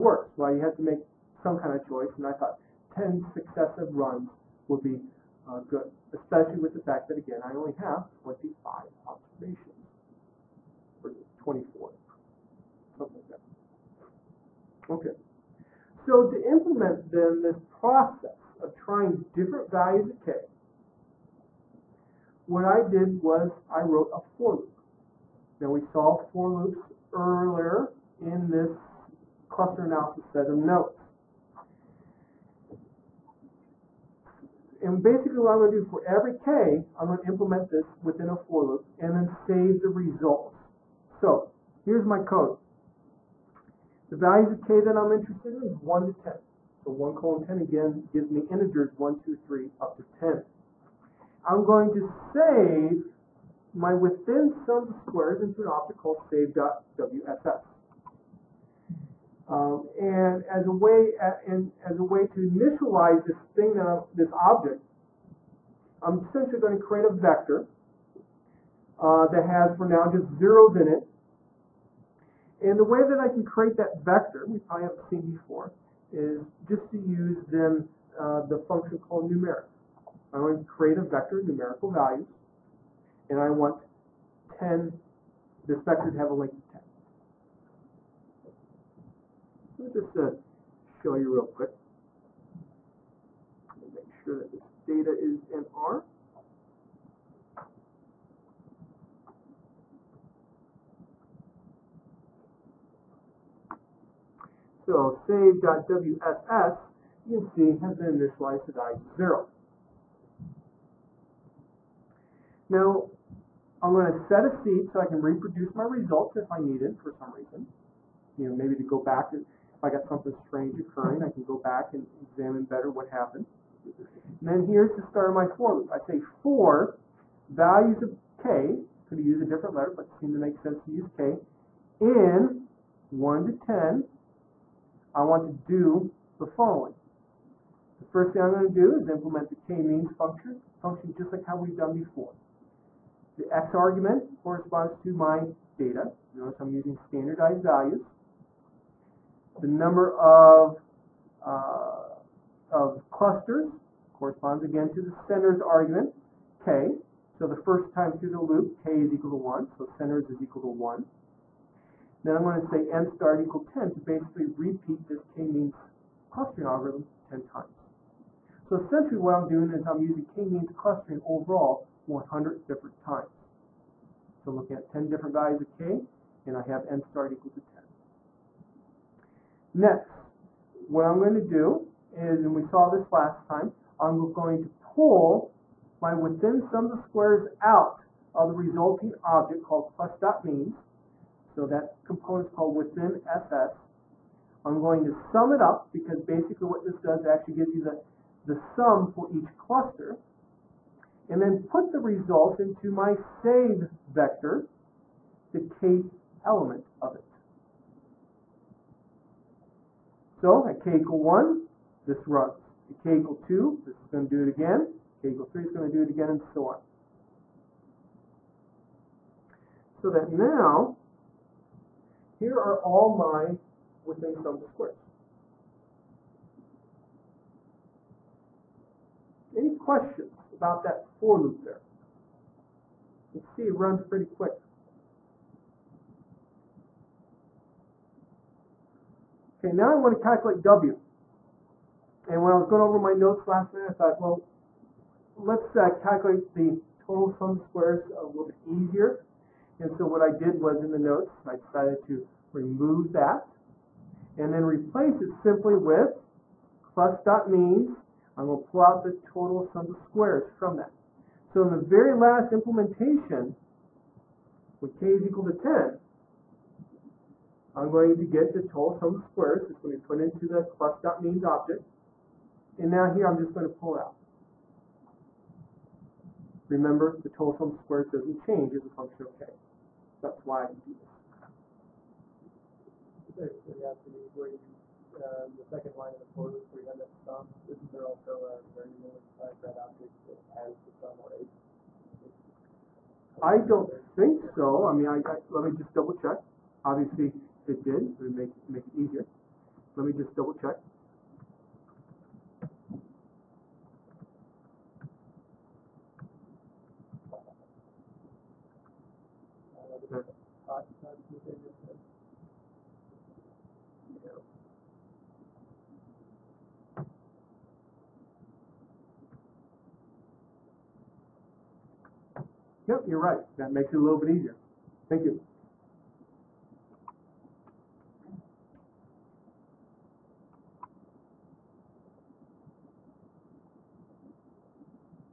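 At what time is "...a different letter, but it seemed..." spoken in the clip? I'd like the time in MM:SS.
02:09.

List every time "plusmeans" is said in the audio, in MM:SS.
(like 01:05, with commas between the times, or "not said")
03:09, 04:30.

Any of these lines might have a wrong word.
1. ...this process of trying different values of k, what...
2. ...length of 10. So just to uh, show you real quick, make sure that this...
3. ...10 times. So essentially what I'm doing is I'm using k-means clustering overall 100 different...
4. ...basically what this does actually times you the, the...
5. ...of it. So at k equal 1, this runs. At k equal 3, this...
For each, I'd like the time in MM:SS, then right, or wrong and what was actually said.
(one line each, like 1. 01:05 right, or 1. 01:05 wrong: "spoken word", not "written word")
1. 00:17 right
2. 01:26 right
3. 02:47 right
4. 03:16 wrong: "gives", not "times"
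5. 03:27 wrong: "2", not "3".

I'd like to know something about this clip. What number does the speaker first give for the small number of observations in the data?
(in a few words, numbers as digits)
25.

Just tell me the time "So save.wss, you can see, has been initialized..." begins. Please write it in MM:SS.
01:44.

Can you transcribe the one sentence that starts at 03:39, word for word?
So that now, here are all my within sums of squares.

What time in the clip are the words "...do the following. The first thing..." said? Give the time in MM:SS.
02:15.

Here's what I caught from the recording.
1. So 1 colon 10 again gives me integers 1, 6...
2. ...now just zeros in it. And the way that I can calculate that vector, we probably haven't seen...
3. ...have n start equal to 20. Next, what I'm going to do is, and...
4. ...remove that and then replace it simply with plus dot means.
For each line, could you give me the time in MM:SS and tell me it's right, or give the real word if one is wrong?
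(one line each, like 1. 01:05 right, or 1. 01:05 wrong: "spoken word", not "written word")
1. 00:46 wrong: "2", not "6"
2. 01:09 wrong: "create", not "calculate"
3. 02:56 wrong: "10", not "20"
4. 04:12 right.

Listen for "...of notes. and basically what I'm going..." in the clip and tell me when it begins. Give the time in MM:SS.
00:30.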